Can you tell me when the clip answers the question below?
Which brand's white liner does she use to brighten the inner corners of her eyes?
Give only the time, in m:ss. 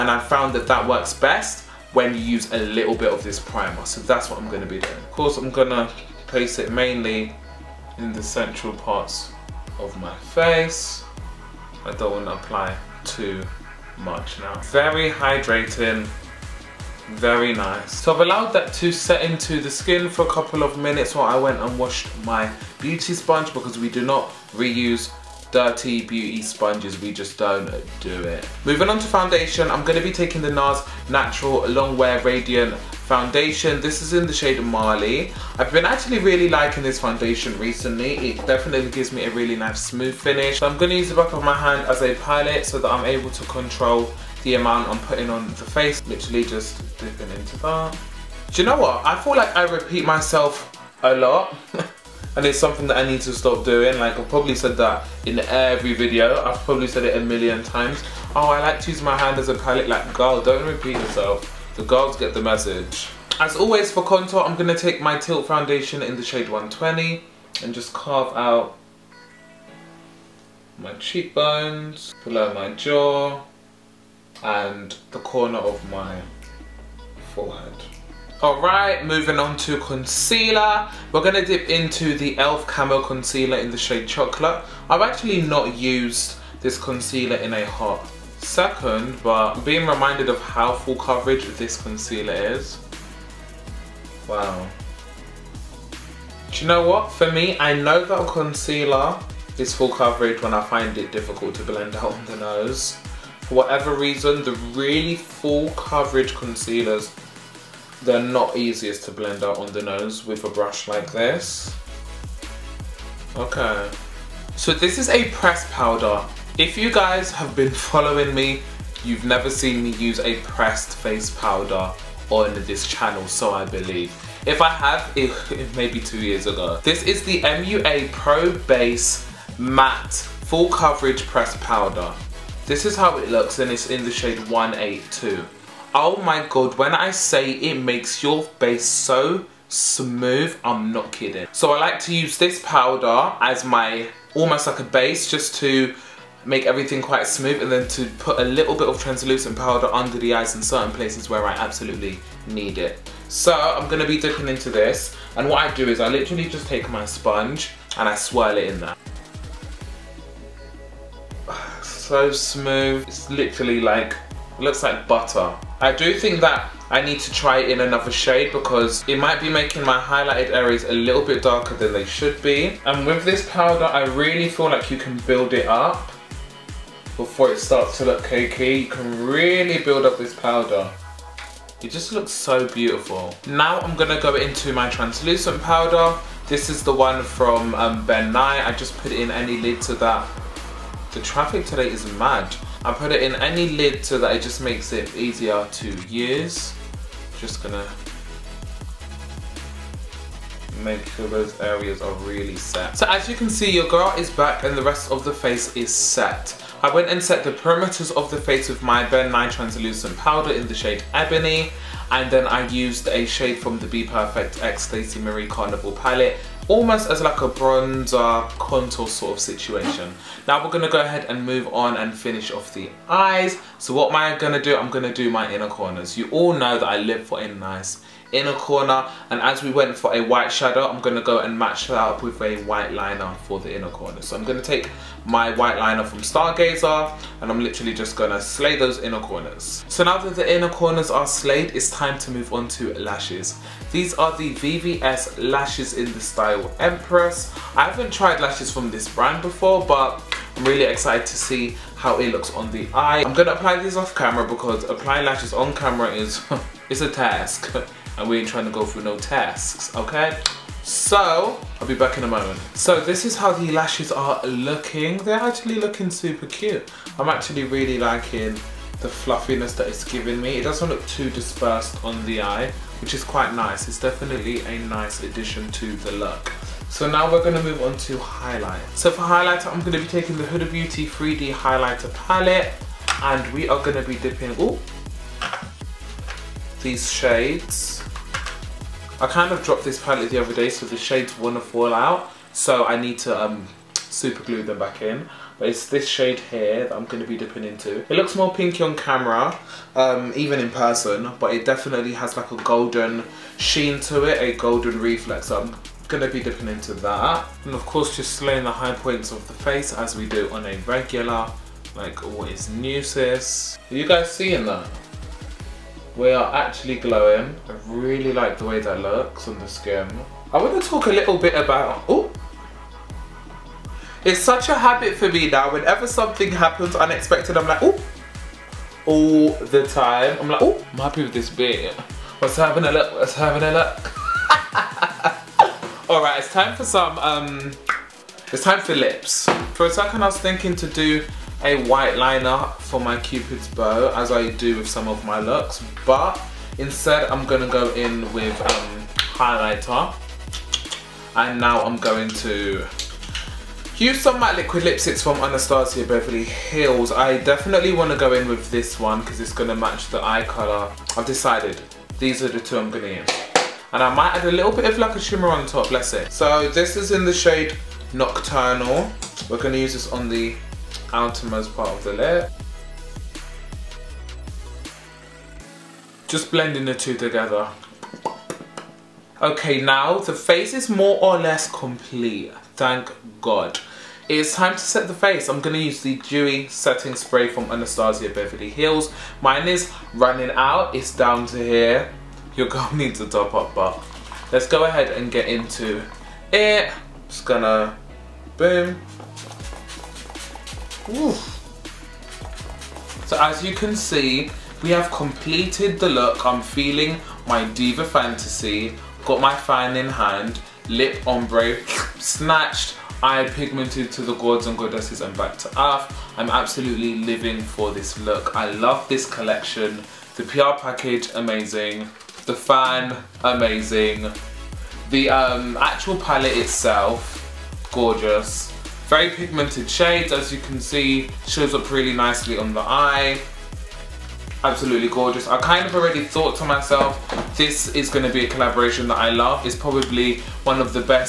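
3:56.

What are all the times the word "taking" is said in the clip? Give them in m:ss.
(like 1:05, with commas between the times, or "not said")
0:30, 4:40.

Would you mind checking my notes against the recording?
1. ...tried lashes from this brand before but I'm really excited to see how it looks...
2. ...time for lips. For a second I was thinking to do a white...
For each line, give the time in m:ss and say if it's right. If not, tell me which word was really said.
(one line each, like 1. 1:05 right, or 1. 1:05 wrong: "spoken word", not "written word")
1. 4:08 right
2. 5:38 right.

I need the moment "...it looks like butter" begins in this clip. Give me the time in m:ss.
2:44.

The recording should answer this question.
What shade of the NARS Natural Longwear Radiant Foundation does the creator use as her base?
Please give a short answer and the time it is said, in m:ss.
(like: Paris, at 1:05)
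Mali, at 0:34.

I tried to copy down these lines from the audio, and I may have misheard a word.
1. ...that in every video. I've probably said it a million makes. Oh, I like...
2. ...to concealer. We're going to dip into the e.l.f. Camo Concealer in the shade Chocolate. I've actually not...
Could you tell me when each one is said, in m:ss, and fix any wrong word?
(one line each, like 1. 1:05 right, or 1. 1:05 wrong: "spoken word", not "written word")
1. 0:54 wrong: "times", not "makes"
2. 1:19 right.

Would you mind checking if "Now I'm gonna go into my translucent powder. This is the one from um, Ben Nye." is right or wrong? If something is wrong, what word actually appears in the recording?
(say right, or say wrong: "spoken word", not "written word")
right.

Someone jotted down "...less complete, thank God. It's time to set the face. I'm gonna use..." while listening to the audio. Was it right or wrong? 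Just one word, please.
right.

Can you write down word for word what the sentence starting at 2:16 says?
Oh my god, when I say it makes your face so smooth, I'm not kidding.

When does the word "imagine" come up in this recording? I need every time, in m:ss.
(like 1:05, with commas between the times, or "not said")
not said.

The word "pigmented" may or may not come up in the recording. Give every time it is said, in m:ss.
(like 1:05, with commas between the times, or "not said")
6:53, 7:09.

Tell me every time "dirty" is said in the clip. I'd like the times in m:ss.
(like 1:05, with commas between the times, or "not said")
0:25.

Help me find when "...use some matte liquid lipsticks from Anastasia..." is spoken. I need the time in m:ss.
5:53.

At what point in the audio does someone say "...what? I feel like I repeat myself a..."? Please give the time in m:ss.
0:48.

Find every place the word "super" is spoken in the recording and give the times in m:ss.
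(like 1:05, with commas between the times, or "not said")
4:26, 4:53.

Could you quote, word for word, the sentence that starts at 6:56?
I'm absolutely living for this look.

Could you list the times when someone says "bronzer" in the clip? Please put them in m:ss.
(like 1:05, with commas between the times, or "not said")
3:37.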